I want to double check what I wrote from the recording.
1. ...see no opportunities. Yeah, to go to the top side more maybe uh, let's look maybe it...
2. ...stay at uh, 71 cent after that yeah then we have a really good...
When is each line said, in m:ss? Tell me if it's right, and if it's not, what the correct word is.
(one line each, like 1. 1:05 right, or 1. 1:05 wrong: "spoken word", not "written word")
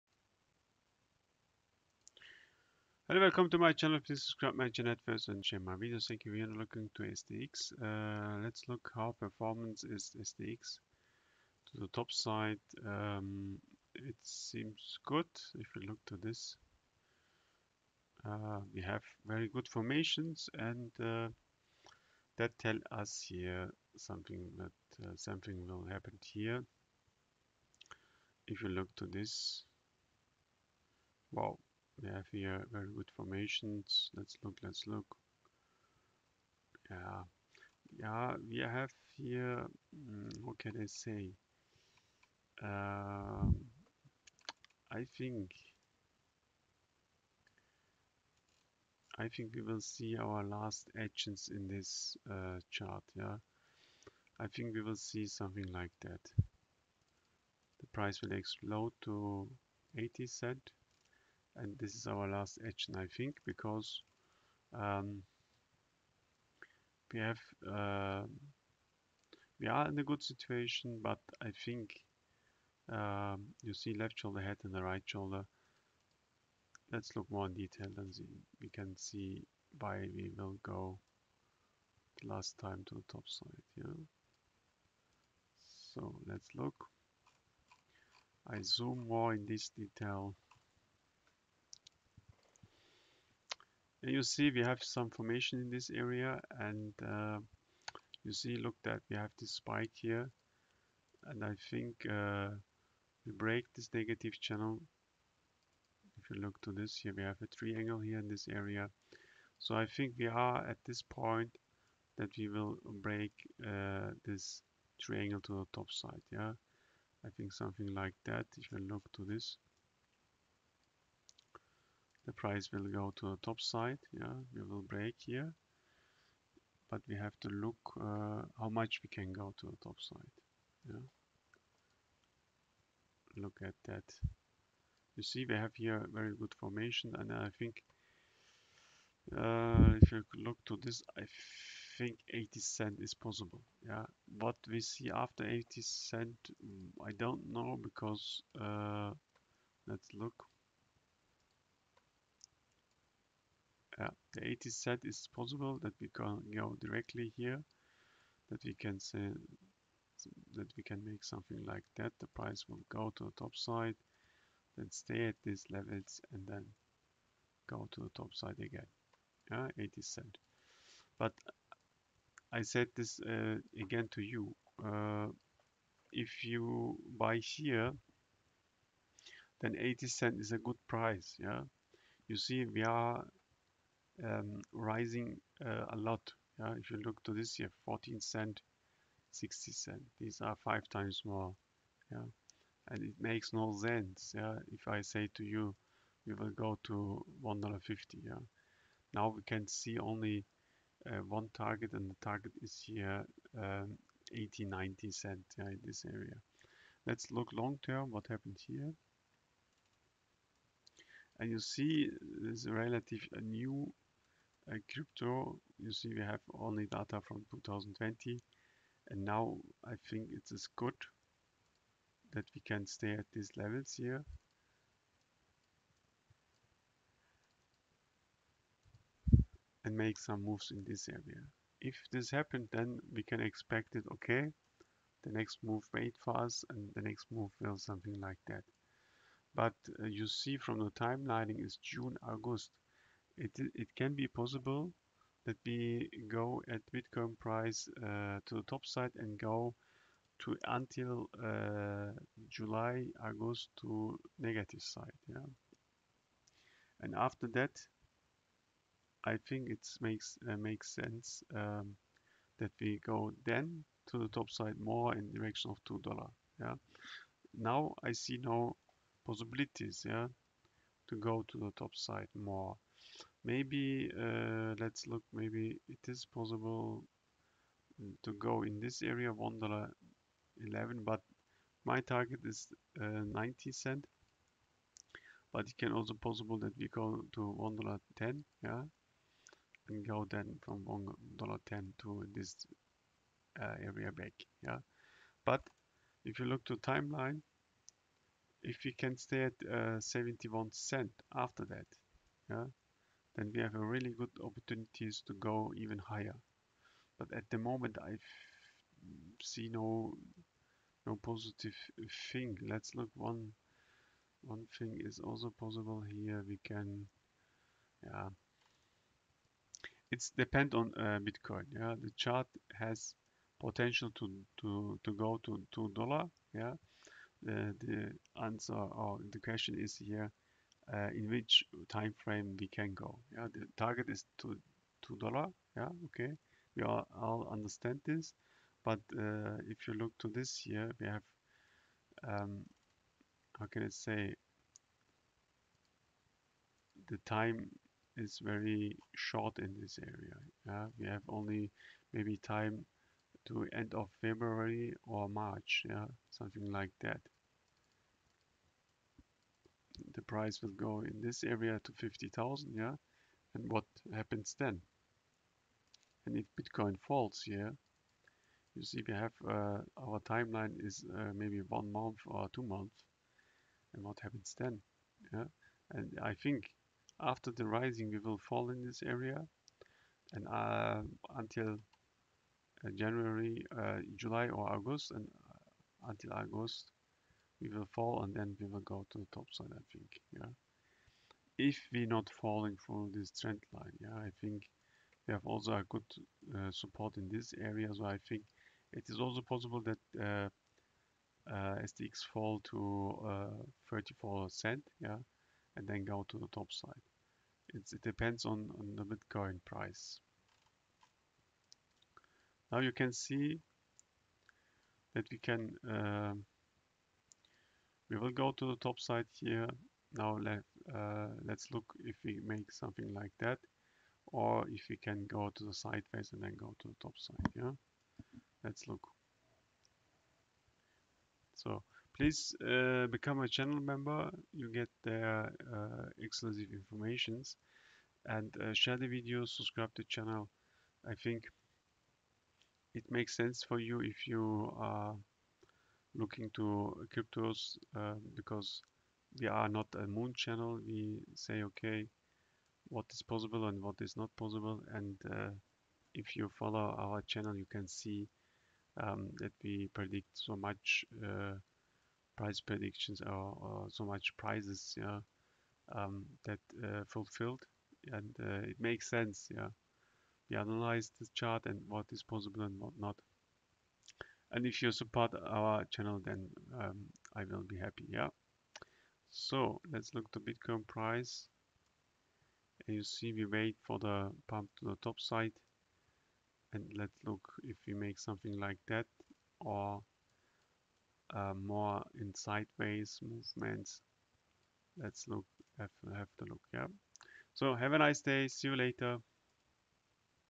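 1. 4:28 wrong: "possibilities", not "opportunities"
2. 4:59 right.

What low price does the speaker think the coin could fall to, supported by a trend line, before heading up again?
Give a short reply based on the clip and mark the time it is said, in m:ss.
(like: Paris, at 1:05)
34 cents, at 6:43.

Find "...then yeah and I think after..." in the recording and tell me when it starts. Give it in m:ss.
6:14.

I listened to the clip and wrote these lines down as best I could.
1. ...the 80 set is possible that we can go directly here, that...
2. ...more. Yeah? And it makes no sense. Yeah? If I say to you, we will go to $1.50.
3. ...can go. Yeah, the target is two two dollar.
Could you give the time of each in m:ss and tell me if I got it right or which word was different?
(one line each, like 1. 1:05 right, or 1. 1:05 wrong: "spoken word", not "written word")
1. 2:34 right
2. 3:11 right
3. 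5:32 right.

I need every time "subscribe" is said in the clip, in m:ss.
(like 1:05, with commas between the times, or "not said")
0:04, 7:19.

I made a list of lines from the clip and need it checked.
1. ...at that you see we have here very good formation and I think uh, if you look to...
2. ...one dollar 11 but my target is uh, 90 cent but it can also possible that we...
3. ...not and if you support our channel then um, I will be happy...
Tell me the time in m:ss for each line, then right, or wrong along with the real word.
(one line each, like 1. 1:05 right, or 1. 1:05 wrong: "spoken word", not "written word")
1. 2:13 right
2. 4:39 right
3. 7:52 right.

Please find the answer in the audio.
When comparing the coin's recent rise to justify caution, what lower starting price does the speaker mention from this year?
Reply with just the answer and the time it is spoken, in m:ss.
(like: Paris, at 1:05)
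14 cents, at 3:07.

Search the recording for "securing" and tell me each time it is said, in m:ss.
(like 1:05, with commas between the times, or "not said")
not said.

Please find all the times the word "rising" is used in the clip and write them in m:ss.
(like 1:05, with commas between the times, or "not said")
3:04, 6:17.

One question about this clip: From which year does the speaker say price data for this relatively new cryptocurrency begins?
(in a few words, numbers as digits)
2020.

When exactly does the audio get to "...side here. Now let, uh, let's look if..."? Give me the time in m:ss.
6:58.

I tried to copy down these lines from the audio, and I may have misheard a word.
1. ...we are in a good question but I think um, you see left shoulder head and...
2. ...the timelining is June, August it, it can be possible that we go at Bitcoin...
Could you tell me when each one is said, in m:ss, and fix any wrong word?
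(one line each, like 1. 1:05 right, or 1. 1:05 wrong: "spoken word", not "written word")
1. 1:09 wrong: "situation", not "question"
2. 4:00 right.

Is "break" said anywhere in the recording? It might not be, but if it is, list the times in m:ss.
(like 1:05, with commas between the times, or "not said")
1:43, 1:53, 2:04.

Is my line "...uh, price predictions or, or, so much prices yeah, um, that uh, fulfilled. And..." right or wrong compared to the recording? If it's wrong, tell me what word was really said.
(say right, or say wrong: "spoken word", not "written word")
right.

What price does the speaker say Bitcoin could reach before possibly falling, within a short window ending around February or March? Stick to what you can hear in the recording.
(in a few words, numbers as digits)
50,000.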